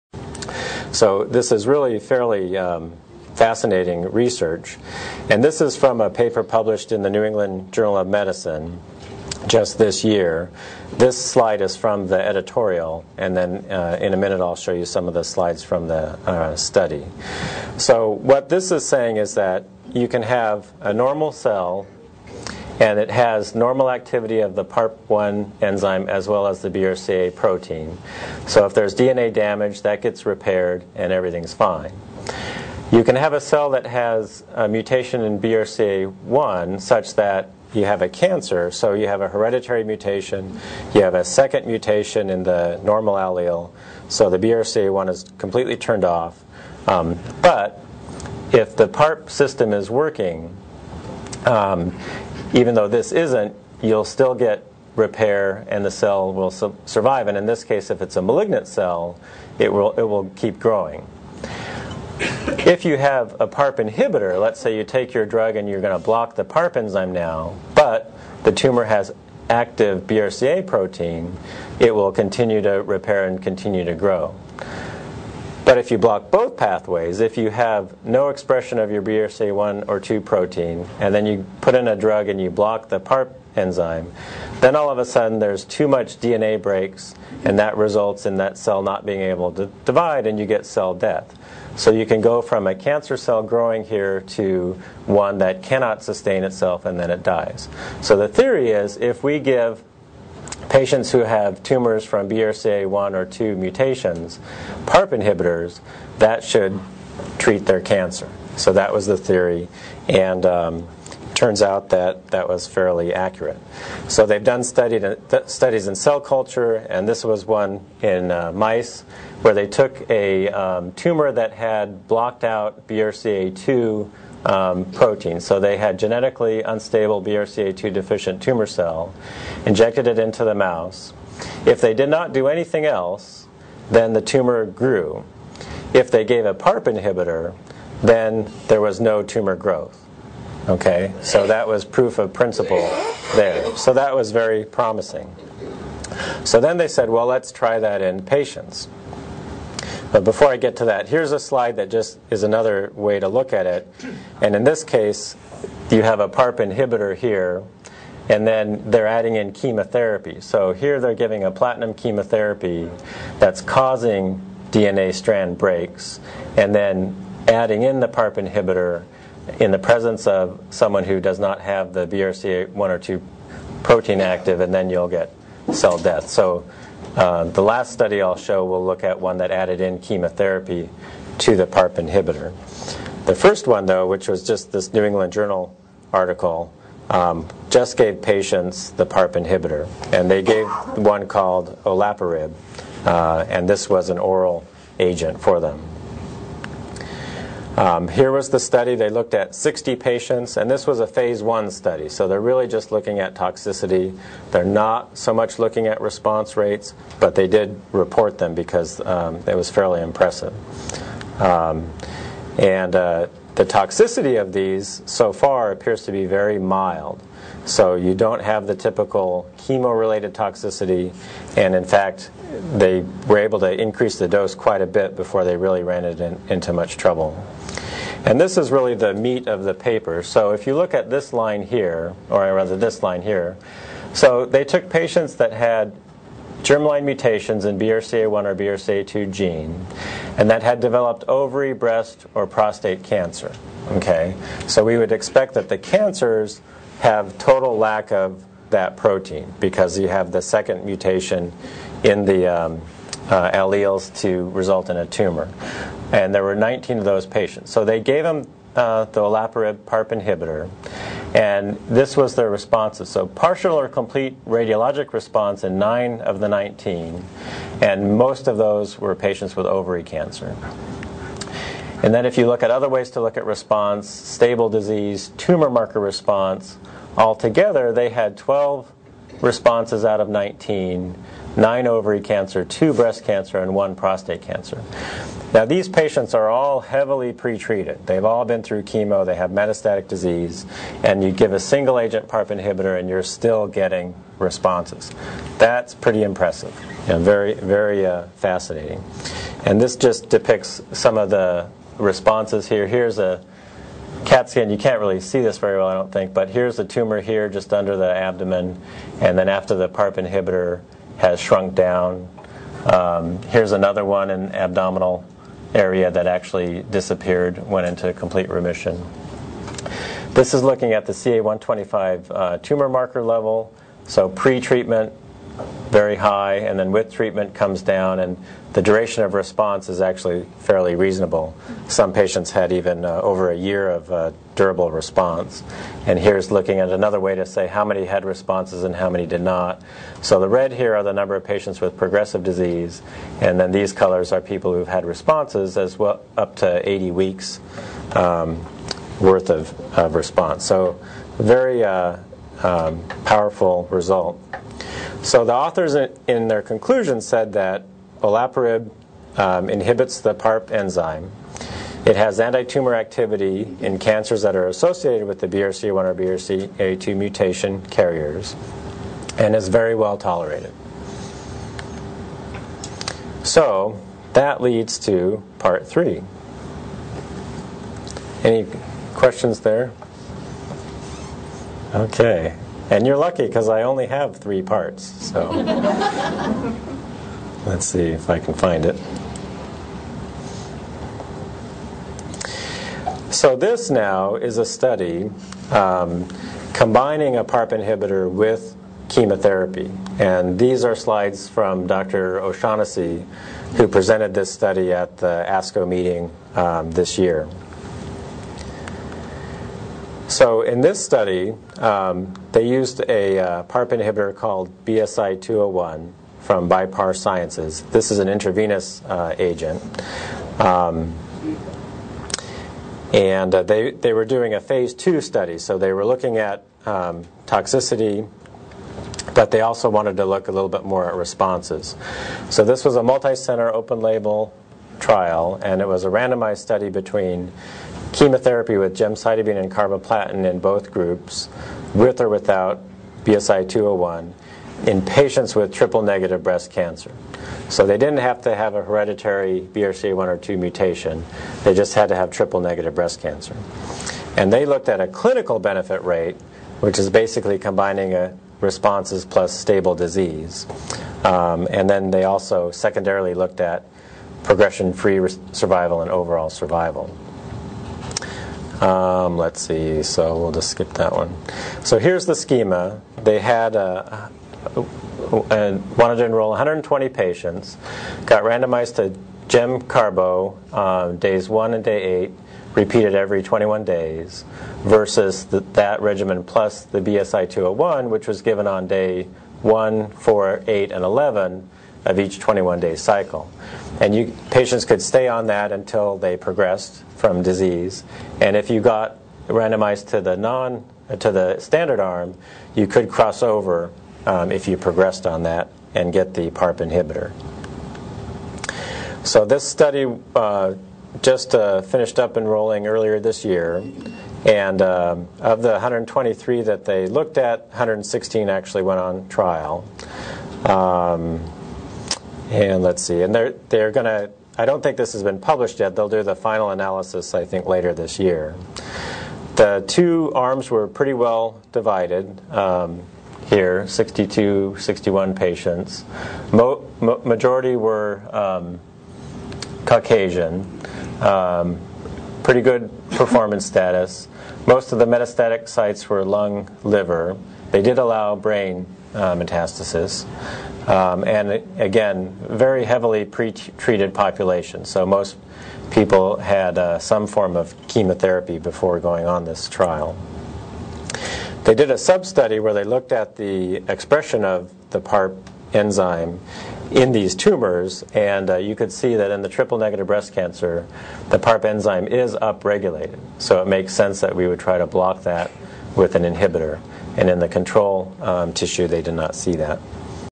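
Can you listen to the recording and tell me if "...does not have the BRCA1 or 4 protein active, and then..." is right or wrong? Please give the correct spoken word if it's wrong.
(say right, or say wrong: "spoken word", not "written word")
wrong: "2", not "4".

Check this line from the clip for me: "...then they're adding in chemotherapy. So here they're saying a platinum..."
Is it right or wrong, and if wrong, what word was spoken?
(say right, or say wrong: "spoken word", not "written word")
wrong: "giving", not "saying".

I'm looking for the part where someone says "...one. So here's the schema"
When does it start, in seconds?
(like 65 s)
471 s.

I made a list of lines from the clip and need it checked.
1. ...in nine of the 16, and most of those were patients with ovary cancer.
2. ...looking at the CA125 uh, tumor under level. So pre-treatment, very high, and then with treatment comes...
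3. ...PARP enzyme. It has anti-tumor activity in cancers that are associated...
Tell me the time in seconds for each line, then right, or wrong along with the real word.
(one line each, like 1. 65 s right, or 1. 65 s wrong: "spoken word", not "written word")
1. 265 s wrong: "19", not "16"
2. 320 s wrong: "marker", not "under"
3. 360 s right.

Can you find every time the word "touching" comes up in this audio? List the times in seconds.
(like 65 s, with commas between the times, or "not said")
not said.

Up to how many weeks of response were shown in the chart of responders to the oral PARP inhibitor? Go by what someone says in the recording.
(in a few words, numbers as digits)
80 weeks.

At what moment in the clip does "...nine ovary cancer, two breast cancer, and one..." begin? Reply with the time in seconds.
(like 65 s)
281 s.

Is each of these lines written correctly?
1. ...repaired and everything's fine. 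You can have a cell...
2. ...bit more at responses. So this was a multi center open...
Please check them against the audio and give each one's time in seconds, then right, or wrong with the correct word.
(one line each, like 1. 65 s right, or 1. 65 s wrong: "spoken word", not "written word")
1. 30 s right
2. 430 s right.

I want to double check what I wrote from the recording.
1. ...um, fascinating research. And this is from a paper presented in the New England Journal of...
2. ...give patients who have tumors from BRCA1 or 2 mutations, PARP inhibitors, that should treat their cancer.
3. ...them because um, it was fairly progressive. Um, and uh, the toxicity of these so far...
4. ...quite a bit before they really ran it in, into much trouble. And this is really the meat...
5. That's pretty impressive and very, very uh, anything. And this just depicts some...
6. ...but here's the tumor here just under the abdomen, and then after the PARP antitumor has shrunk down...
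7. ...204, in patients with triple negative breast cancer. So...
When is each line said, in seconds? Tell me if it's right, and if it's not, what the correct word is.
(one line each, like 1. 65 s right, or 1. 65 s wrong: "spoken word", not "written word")
1. 2 s wrong: "published", not "presented"
2. 99 s right
3. 208 s wrong: "impressive", not "progressive"
4. 224 s right
5. 295 s wrong: "fascinating", not "anything"
6. 306 s wrong: "inhibitor", not "antitumor"
7. 443 s wrong: "201", not "204".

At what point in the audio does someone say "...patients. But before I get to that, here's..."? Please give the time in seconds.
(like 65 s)
148 s.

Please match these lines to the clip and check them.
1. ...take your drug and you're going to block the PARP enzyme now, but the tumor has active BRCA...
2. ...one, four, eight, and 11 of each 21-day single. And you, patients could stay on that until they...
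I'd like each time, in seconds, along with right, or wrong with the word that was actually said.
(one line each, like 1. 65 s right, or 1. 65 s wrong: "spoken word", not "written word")
1. 64 s right
2. 489 s wrong: "cycle", not "single".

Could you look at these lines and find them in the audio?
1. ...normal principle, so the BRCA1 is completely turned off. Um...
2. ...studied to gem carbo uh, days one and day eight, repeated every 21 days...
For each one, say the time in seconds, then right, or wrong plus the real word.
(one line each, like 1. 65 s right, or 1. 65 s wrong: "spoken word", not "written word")
1. 42 s wrong: "allele", not "principle"
2. 478 s wrong: "randomized", not "studied".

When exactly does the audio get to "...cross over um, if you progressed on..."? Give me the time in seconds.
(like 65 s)
503 s.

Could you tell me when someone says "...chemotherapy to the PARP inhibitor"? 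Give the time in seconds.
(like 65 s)
179 s.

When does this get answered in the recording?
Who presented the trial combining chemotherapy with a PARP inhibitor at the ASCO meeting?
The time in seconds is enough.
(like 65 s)
401 s.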